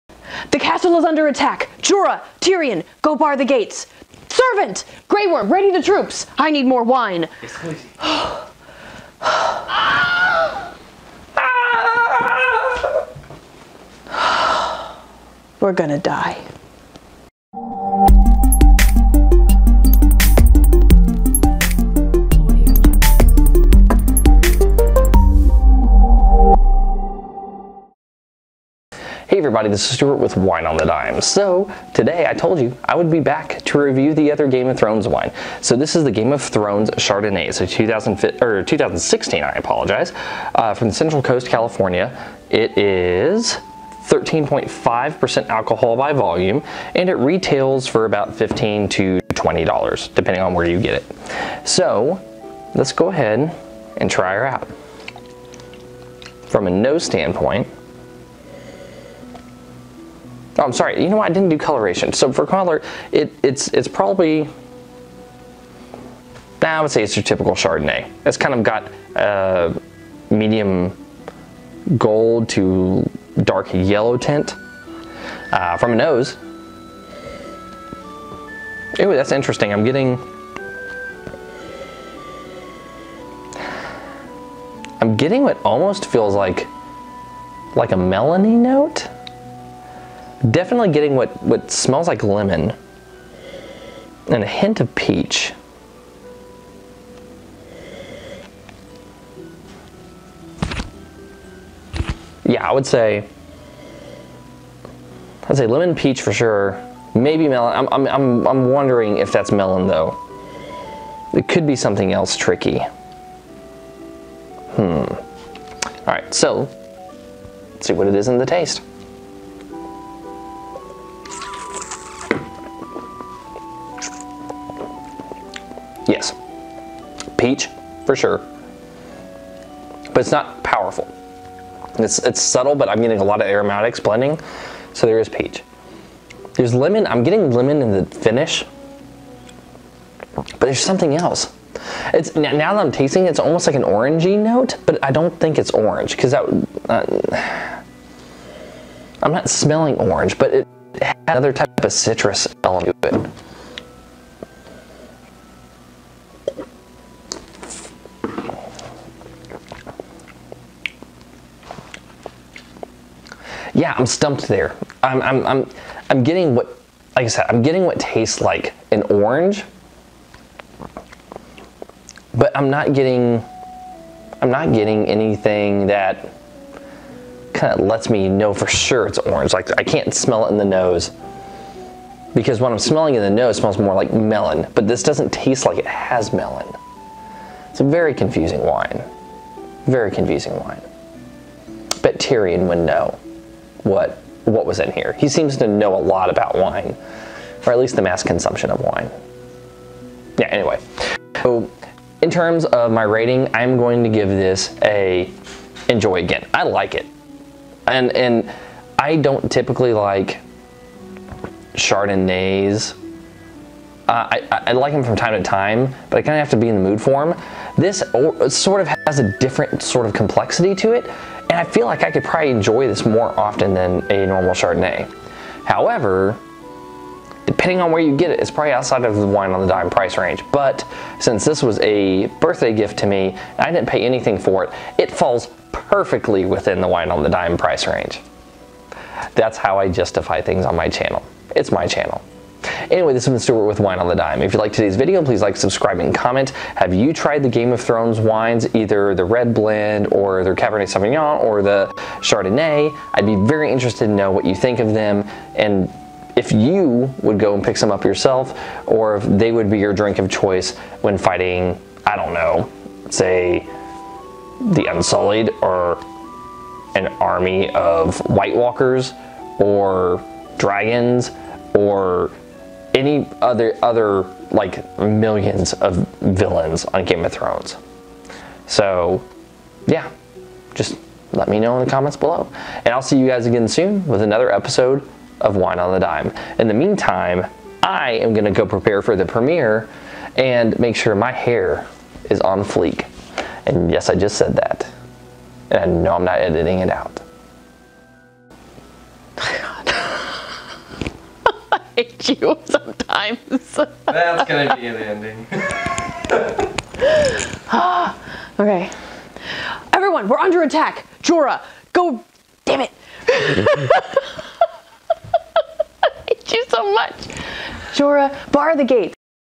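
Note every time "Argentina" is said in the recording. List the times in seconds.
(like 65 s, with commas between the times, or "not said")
not said.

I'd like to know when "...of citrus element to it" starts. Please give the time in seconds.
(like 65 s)
151 s.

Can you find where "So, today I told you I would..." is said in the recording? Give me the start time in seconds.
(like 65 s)
31 s.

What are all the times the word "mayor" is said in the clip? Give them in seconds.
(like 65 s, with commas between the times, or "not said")
not said.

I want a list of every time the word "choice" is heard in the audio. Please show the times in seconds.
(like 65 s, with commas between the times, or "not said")
260 s.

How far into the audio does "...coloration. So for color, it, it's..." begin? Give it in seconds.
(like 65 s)
61 s.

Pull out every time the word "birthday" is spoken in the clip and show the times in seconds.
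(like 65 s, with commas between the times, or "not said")
232 s.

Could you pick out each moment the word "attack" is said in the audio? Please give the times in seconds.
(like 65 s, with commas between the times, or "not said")
1 s, 310 s.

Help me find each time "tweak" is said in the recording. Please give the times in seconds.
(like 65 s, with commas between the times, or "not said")
not said.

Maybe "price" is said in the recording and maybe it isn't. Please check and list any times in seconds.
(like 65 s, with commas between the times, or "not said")
229 s, 237 s.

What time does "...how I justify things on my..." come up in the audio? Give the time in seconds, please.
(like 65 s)
239 s.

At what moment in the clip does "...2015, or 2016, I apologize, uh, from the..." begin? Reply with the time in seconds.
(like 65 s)
37 s.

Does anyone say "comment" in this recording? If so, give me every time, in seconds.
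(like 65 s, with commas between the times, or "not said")
246 s, 281 s.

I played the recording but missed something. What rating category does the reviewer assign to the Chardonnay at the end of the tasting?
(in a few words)
Enjoy again.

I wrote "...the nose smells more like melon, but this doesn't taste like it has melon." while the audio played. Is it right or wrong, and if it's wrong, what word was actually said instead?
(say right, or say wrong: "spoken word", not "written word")
right.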